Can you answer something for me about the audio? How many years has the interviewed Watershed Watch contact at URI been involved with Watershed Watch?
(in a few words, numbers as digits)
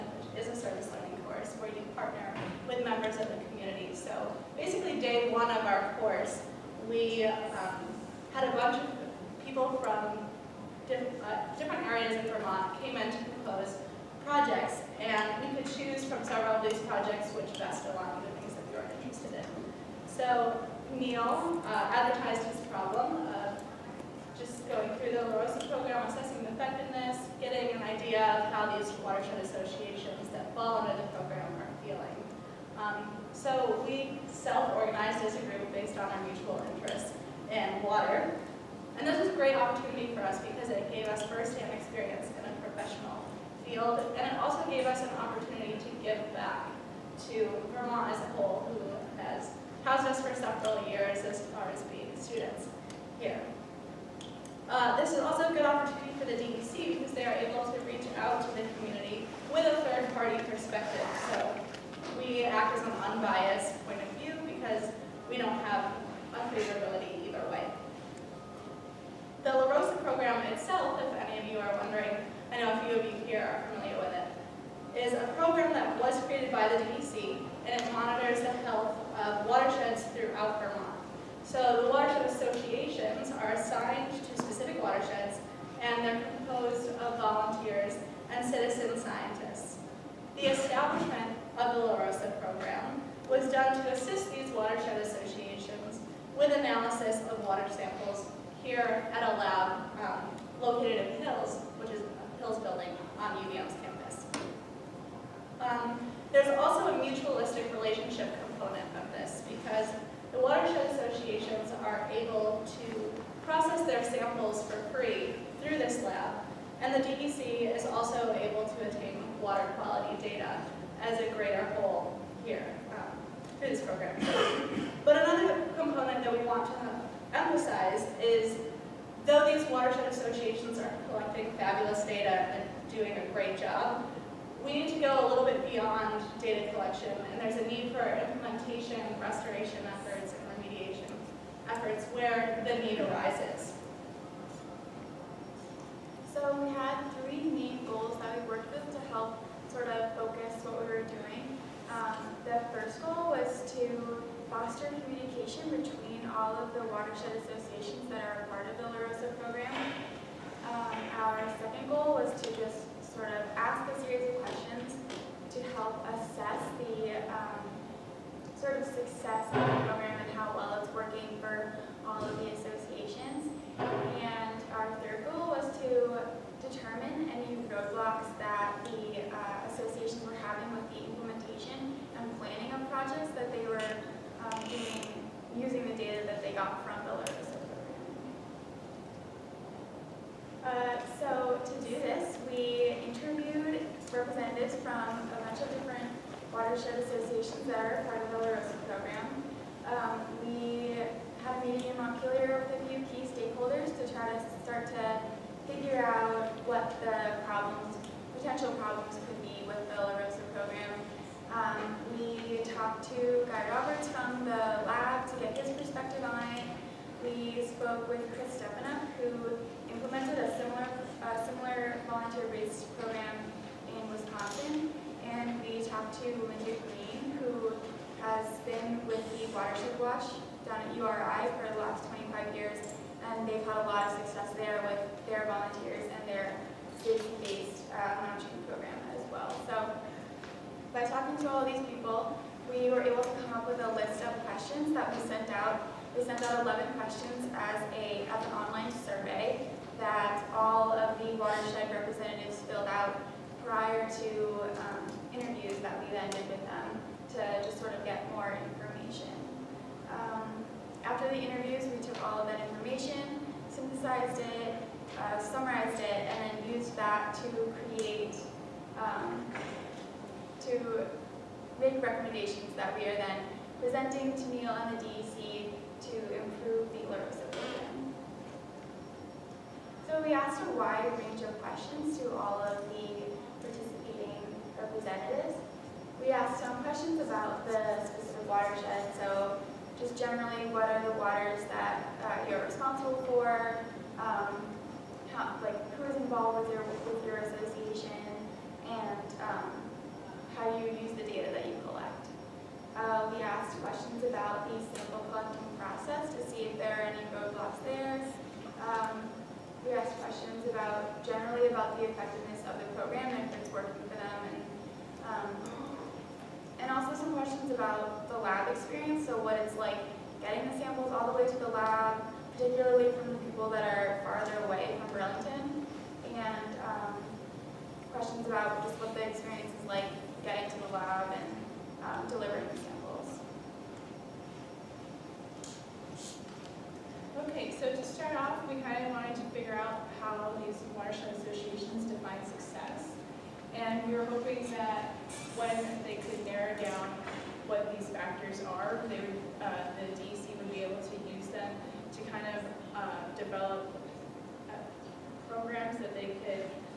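25.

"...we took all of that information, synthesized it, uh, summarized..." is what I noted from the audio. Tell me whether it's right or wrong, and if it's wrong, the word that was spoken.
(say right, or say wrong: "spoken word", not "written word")
right.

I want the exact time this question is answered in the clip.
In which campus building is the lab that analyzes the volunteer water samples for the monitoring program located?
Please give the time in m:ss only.
1:42.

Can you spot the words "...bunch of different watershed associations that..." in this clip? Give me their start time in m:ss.
3:15.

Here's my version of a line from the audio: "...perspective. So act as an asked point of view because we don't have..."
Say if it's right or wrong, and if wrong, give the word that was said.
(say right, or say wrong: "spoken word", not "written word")
wrong: "unbiased", not "asked".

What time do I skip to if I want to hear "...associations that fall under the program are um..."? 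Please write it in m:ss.
0:29.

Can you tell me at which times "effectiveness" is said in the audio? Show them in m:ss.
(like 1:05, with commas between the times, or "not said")
0:26, 5:12.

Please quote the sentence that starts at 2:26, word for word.
So we had three main goals watershed associations that are a part of the La Rosa program.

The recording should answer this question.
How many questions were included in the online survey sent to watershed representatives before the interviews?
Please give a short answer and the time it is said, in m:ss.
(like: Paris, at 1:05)
11, at 4:06.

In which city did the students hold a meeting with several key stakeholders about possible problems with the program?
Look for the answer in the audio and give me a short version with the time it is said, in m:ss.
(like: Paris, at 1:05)
Montpelier, at 3:21.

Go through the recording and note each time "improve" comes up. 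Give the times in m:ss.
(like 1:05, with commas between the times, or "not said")
4:36.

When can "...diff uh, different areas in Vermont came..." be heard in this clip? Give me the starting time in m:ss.
0:10.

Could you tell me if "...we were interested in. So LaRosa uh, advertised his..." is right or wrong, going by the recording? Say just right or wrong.
wrong.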